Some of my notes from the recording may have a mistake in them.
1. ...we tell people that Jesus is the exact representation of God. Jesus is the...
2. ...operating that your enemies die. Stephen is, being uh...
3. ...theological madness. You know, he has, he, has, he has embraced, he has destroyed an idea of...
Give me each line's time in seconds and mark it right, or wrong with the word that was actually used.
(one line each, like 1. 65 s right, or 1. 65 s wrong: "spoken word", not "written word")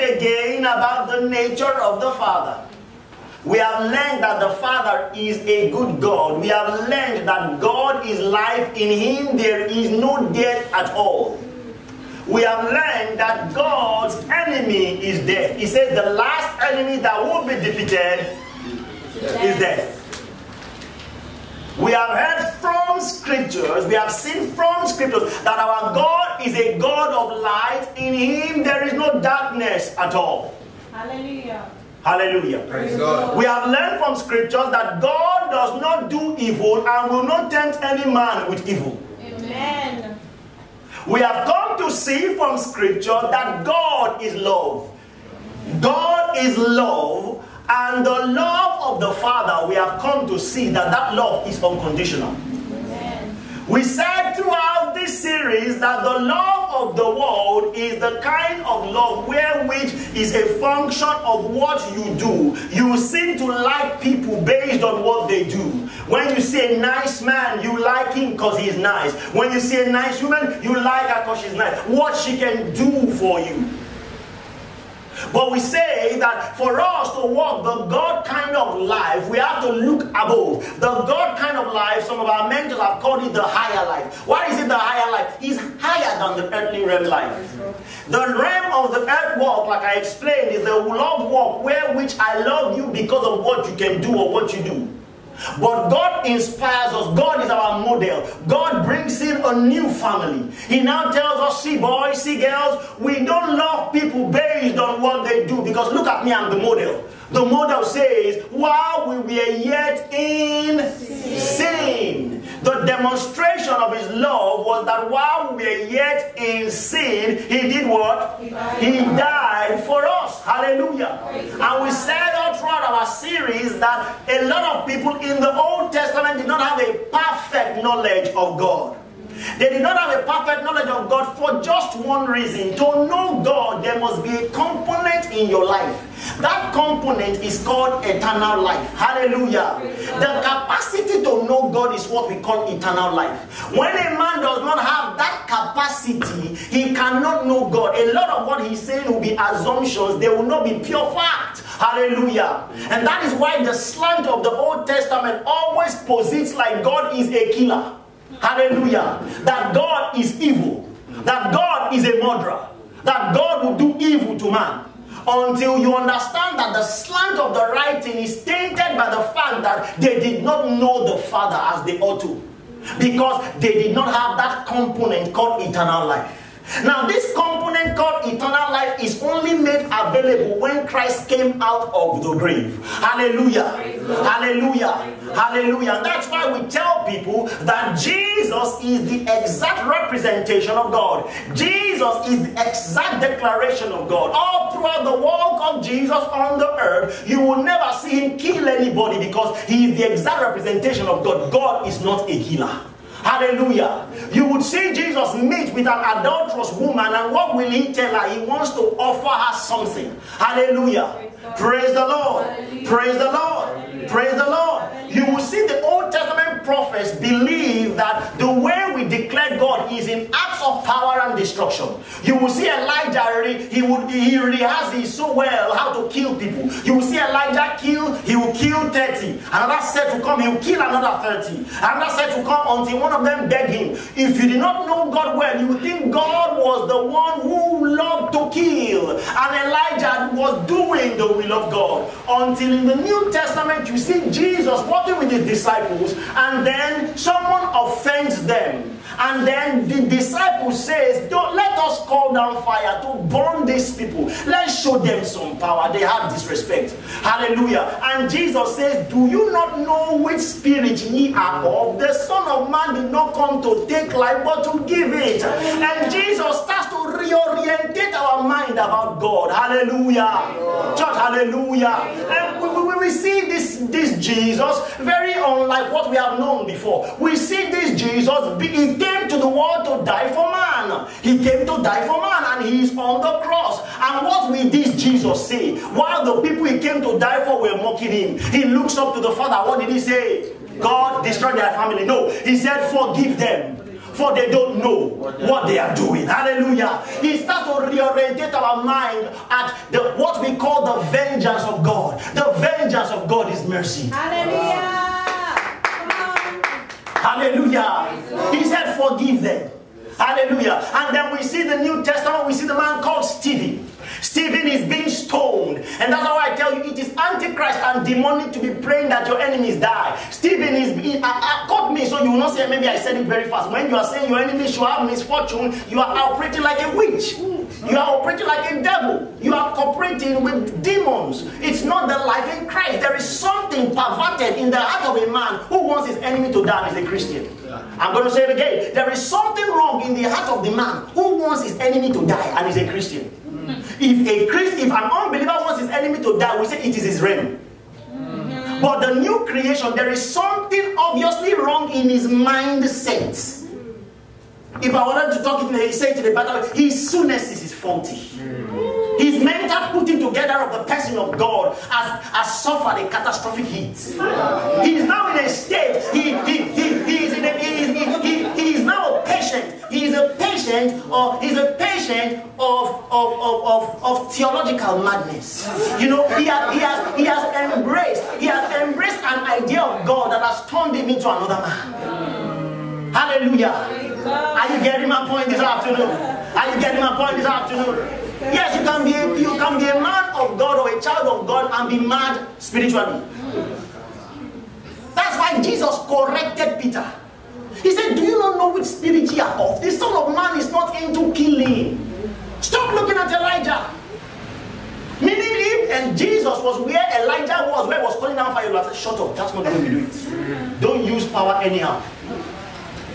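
1. 186 s right
2. 318 s wrong: "praying", not "operating"
3. 374 s wrong: "embraced", not "destroyed".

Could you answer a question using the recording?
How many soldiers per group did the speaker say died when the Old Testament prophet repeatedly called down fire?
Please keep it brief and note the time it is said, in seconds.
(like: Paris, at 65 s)
30, at 228 s.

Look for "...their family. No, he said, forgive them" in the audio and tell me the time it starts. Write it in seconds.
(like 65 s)
291 s.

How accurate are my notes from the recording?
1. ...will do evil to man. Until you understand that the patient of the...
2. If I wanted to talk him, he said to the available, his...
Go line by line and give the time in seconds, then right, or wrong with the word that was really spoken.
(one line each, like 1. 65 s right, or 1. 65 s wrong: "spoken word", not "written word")
1. 163 s wrong: "slant", not "patient"
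2. 354 s wrong: "battle", not "available".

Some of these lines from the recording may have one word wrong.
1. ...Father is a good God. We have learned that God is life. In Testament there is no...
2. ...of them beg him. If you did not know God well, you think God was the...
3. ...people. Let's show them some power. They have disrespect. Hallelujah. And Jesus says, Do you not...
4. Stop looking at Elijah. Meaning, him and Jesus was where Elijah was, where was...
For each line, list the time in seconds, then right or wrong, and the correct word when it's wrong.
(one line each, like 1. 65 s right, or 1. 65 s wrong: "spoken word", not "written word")
1. 4 s wrong: "Him", not "Testament"
2. 233 s right
3. 253 s right
4. 402 s right.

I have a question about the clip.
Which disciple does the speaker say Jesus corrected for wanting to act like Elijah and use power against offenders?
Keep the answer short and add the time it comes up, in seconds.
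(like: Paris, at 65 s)
Peter, at 395 s.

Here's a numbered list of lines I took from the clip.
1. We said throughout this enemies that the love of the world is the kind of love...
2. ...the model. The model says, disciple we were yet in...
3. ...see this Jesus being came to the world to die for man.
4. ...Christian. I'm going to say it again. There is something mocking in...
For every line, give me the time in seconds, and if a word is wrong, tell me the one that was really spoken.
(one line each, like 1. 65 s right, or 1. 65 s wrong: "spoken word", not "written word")
1. 53 s wrong: "series", not "enemies"
2. 106 s wrong: "while", not "disciple"
3. 277 s right
4. 337 s wrong: "wrong", not "mocking".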